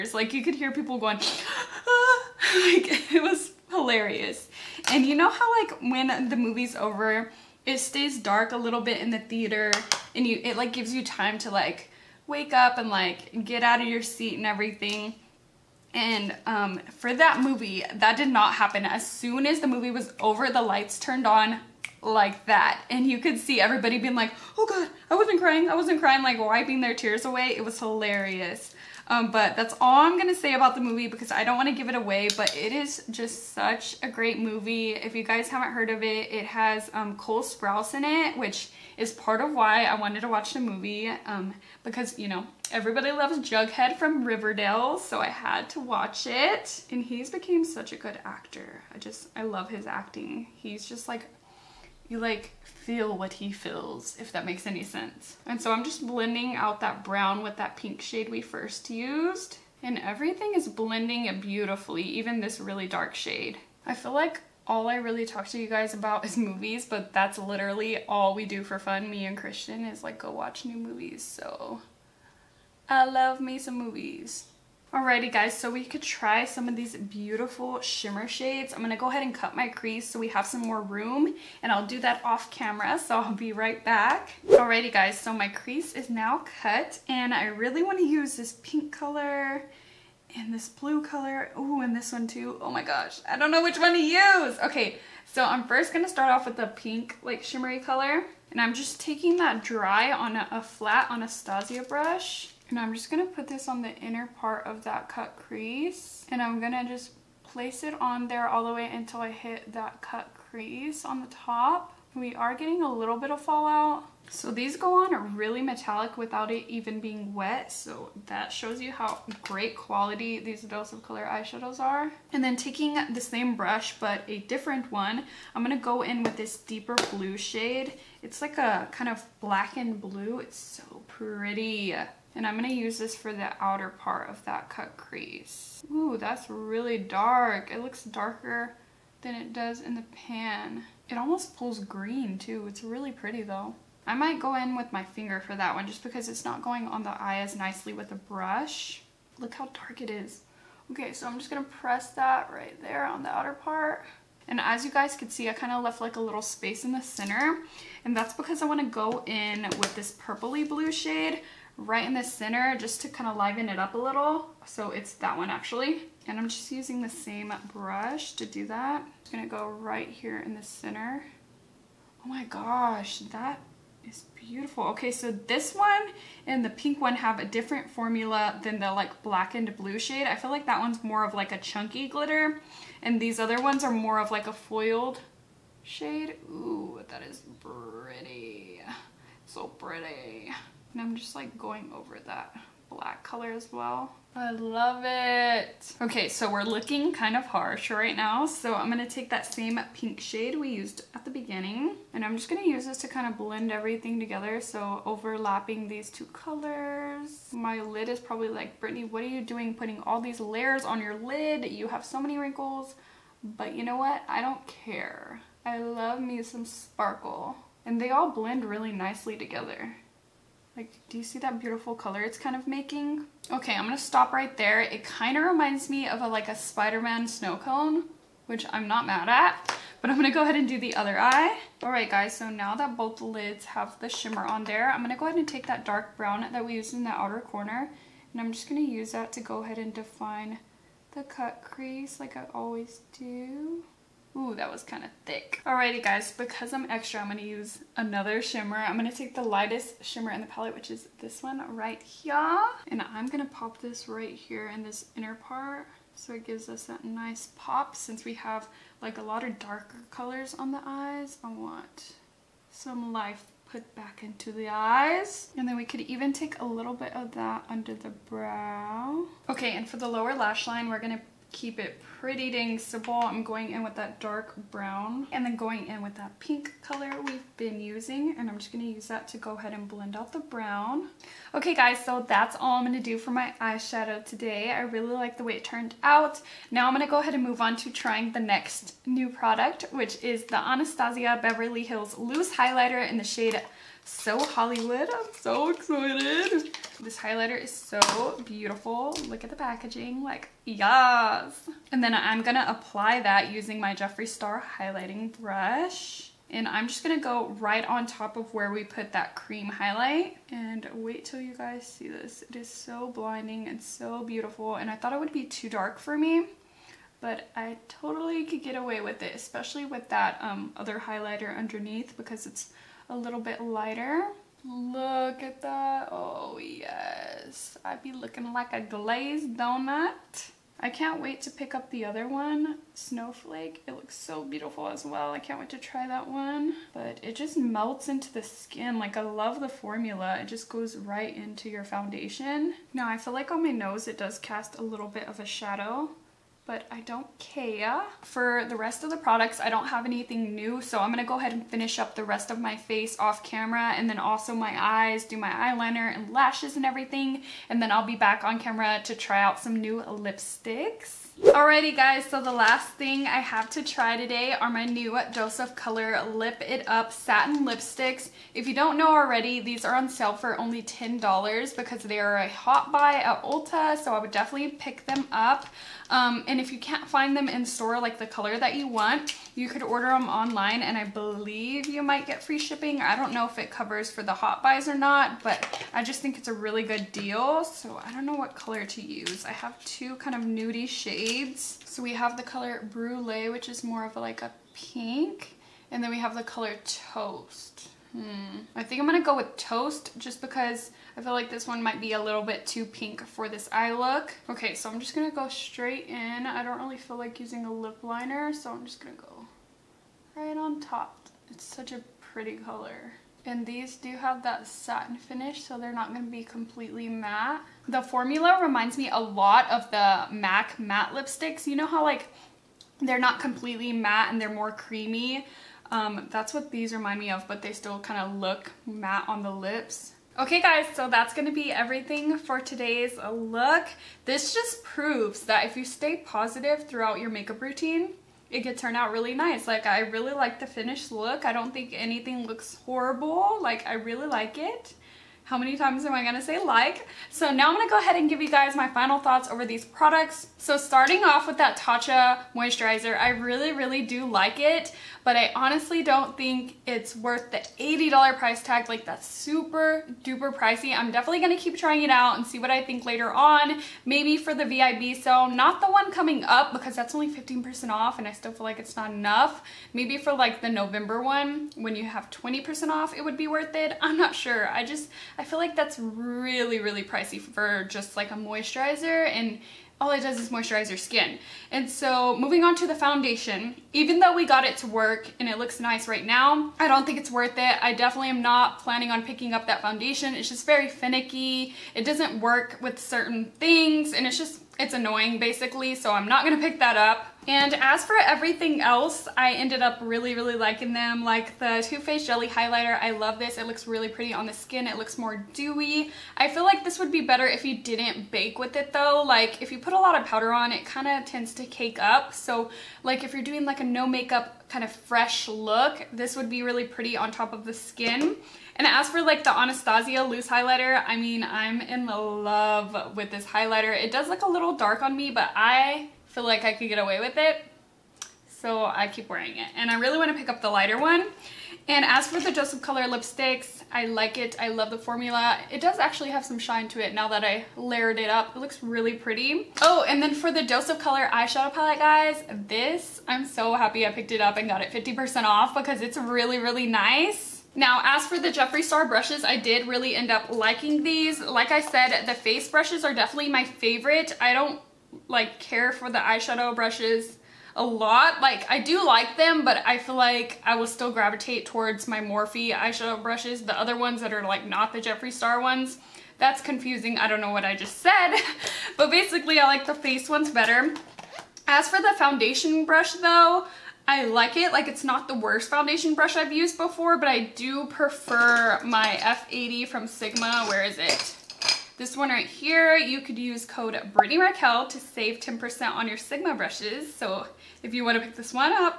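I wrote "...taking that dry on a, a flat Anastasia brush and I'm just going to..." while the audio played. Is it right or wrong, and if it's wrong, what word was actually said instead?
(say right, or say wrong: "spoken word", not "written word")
right.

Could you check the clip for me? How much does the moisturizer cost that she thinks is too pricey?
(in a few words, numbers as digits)
$80.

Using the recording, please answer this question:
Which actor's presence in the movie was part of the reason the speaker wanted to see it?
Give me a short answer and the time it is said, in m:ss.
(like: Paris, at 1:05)
Cole Sprouse, at 0:37.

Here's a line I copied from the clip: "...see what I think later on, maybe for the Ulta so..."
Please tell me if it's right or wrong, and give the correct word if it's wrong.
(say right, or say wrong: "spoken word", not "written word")
wrong: "VIB", not "Ulta".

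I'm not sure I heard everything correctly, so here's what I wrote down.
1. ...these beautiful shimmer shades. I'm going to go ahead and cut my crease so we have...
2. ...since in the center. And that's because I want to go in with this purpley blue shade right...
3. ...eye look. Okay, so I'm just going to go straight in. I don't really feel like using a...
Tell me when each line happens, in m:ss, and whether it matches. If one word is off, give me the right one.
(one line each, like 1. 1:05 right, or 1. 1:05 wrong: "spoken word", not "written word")
1. 1:16 right
2. 2:36 wrong: "space", not "since"
3. 6:43 right.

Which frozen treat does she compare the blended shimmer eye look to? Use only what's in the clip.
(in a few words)
Spider-Man snow cone.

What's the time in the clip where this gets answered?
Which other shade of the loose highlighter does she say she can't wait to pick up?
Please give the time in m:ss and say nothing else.
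5:32.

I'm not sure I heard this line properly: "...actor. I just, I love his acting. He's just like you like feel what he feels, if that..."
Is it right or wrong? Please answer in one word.
right.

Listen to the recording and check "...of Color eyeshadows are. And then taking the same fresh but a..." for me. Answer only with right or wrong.
wrong.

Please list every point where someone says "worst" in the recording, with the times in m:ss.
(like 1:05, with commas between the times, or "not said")
9:35.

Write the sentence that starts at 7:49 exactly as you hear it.
Maybe for like the November one, when you have 20% off, it would be worth it.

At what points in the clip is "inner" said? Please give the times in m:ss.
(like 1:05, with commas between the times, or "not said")
1:43, 4:15.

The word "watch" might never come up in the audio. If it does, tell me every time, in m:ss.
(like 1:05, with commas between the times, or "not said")
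0:40, 0:45, 1:10.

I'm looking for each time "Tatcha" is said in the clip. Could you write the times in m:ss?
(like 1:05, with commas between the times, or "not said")
7:31.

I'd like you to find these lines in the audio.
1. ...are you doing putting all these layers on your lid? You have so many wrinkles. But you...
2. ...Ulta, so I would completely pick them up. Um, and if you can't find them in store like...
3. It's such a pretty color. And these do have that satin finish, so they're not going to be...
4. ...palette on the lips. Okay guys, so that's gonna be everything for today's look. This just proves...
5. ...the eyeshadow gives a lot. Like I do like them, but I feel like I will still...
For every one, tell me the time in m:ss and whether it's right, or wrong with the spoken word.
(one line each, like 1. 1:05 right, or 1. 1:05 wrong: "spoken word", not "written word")
1. 3:29 right
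2. 6:13 wrong: "definitely", not "completely"
3. 6:51 right
4. 7:08 wrong: "matte", not "palette"
5. 9:16 wrong: "brushes", not "gives".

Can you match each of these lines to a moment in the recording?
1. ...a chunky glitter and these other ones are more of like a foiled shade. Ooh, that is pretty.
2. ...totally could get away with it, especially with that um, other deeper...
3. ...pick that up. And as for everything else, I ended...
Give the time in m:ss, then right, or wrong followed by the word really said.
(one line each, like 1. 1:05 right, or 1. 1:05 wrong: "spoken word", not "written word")
1. 3:01 right
2. 5:17 wrong: "highlighter", not "deeper"
3. 8:16 right.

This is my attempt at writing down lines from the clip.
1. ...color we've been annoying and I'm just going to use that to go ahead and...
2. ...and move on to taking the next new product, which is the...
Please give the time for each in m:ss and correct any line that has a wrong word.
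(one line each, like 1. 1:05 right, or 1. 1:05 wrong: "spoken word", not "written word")
1. 4:36 wrong: "using", not "annoying"
2. 4:47 wrong: "trying", not "taking".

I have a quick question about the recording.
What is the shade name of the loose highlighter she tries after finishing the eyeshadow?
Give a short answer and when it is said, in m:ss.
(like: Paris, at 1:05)
So Hollywood, at 4:54.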